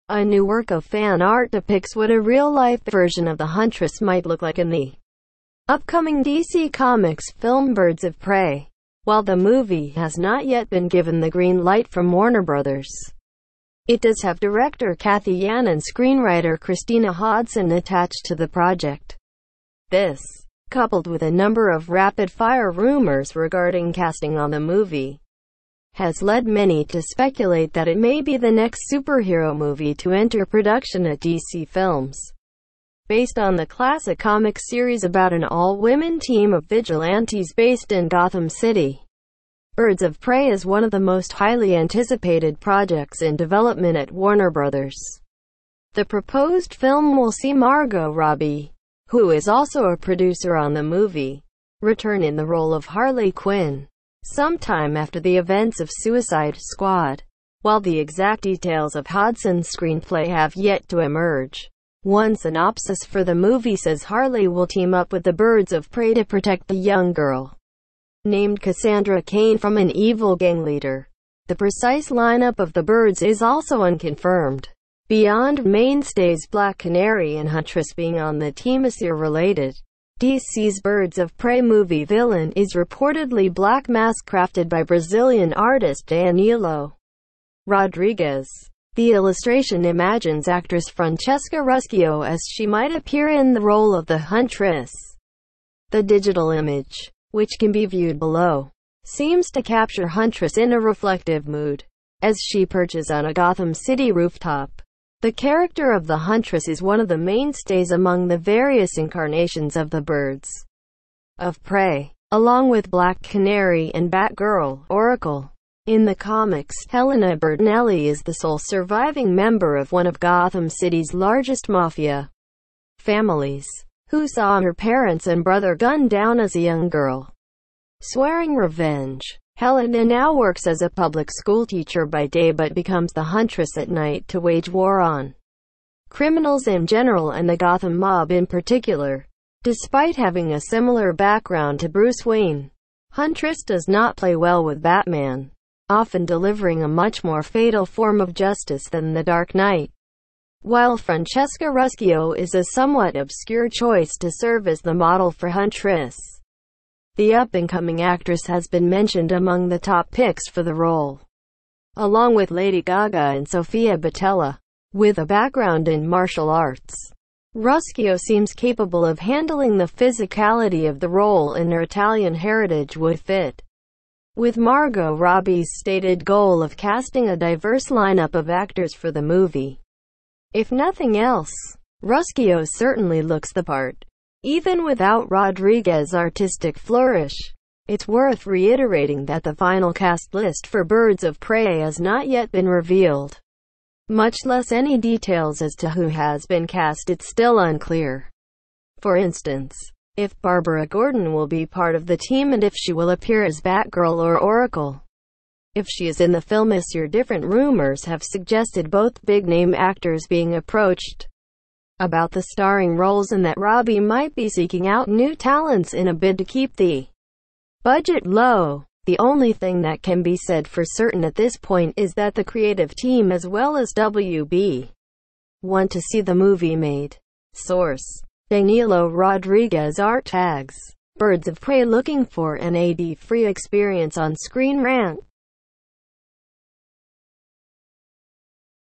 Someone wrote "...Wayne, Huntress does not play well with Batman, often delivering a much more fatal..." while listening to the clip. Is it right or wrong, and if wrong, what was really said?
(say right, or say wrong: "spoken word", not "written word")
right.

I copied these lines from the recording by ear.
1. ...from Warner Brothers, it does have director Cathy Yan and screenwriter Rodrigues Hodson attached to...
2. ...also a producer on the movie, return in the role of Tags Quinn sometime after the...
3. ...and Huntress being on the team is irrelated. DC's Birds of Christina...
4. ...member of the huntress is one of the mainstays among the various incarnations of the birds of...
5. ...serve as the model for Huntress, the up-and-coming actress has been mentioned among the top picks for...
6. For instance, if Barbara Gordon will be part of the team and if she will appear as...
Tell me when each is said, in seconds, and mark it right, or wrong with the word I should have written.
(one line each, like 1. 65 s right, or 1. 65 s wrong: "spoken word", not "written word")
1. 11 s wrong: "Christina", not "Rodrigues"
2. 49 s wrong: "Harley", not "Tags"
3. 77 s wrong: "Prey", not "Christina"
4. 105 s wrong: "character", not "member"
5. 154 s right
6. 198 s right.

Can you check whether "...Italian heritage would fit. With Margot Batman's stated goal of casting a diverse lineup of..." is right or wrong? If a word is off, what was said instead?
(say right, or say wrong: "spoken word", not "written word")
wrong: "Robbie", not "Batman".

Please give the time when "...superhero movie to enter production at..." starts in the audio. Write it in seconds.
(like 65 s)
28 s.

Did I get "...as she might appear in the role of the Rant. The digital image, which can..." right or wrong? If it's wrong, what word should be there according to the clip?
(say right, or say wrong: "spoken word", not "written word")
wrong: "Huntress", not "Rant".